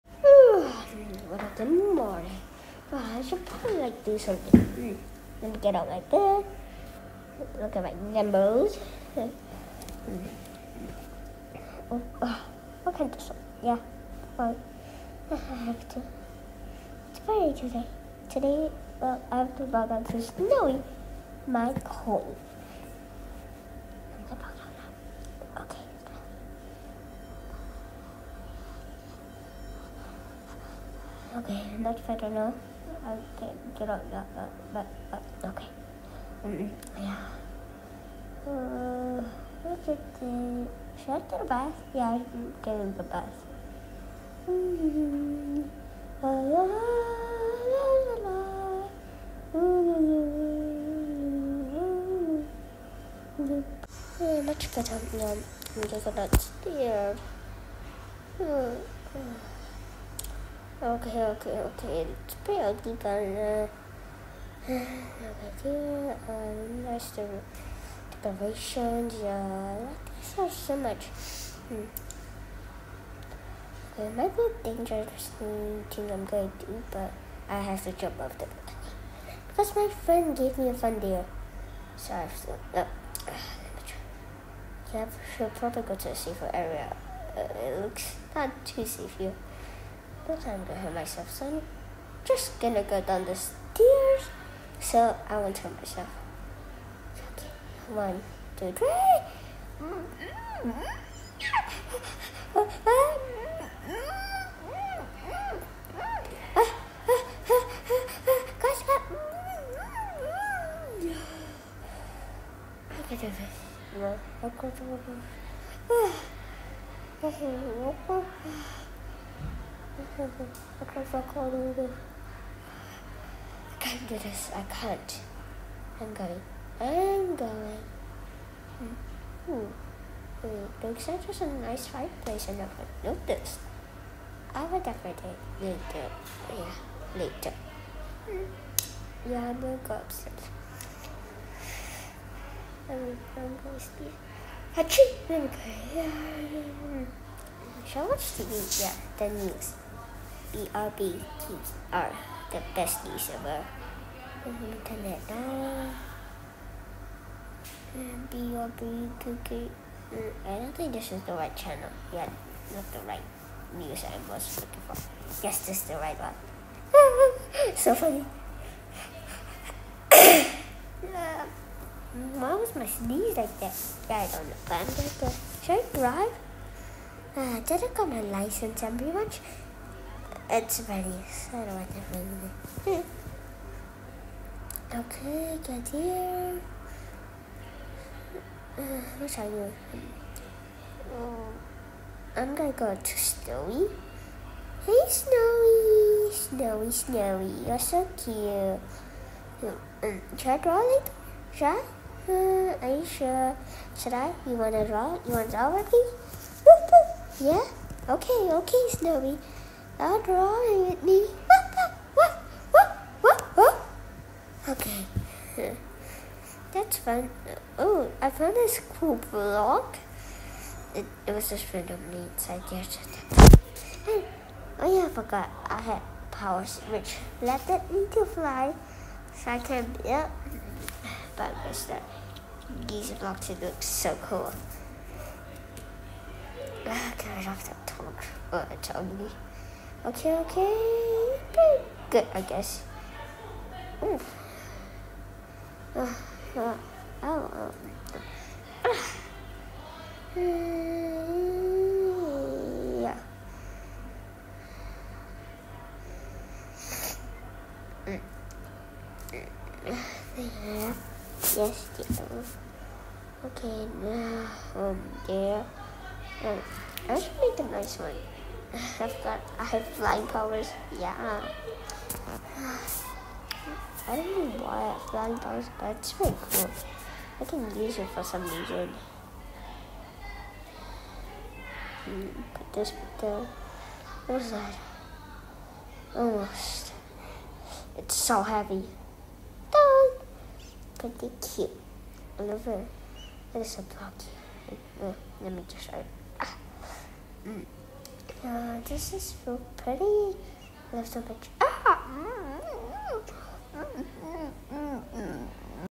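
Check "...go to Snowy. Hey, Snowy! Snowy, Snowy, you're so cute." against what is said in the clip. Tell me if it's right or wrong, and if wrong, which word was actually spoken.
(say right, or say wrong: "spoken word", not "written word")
right.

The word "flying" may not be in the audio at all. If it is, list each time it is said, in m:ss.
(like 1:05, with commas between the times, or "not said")
4:29, 4:35.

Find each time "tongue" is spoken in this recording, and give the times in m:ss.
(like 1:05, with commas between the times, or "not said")
3:57.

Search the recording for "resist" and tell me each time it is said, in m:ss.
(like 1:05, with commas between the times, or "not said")
not said.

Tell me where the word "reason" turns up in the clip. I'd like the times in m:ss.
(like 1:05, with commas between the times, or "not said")
4:38.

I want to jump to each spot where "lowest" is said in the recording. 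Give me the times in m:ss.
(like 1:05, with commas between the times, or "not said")
not said.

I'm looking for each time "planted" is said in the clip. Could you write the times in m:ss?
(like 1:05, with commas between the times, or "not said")
not said.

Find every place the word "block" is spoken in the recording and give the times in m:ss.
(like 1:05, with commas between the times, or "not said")
3:39, 3:53, 4:53.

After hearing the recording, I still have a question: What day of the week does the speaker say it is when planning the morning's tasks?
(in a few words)
Friday.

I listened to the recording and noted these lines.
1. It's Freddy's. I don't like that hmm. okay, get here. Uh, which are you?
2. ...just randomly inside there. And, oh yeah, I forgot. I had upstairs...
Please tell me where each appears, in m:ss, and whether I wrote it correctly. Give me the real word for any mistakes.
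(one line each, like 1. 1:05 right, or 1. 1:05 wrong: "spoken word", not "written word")
1. 3:00 right
2. 3:41 wrong: "powers", not "upstairs".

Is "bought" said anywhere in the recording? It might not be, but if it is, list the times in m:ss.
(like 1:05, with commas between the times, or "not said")
not said.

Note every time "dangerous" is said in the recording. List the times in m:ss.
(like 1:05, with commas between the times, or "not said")
1:14.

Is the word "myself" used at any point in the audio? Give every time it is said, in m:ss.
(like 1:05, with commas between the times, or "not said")
1:30, 1:35.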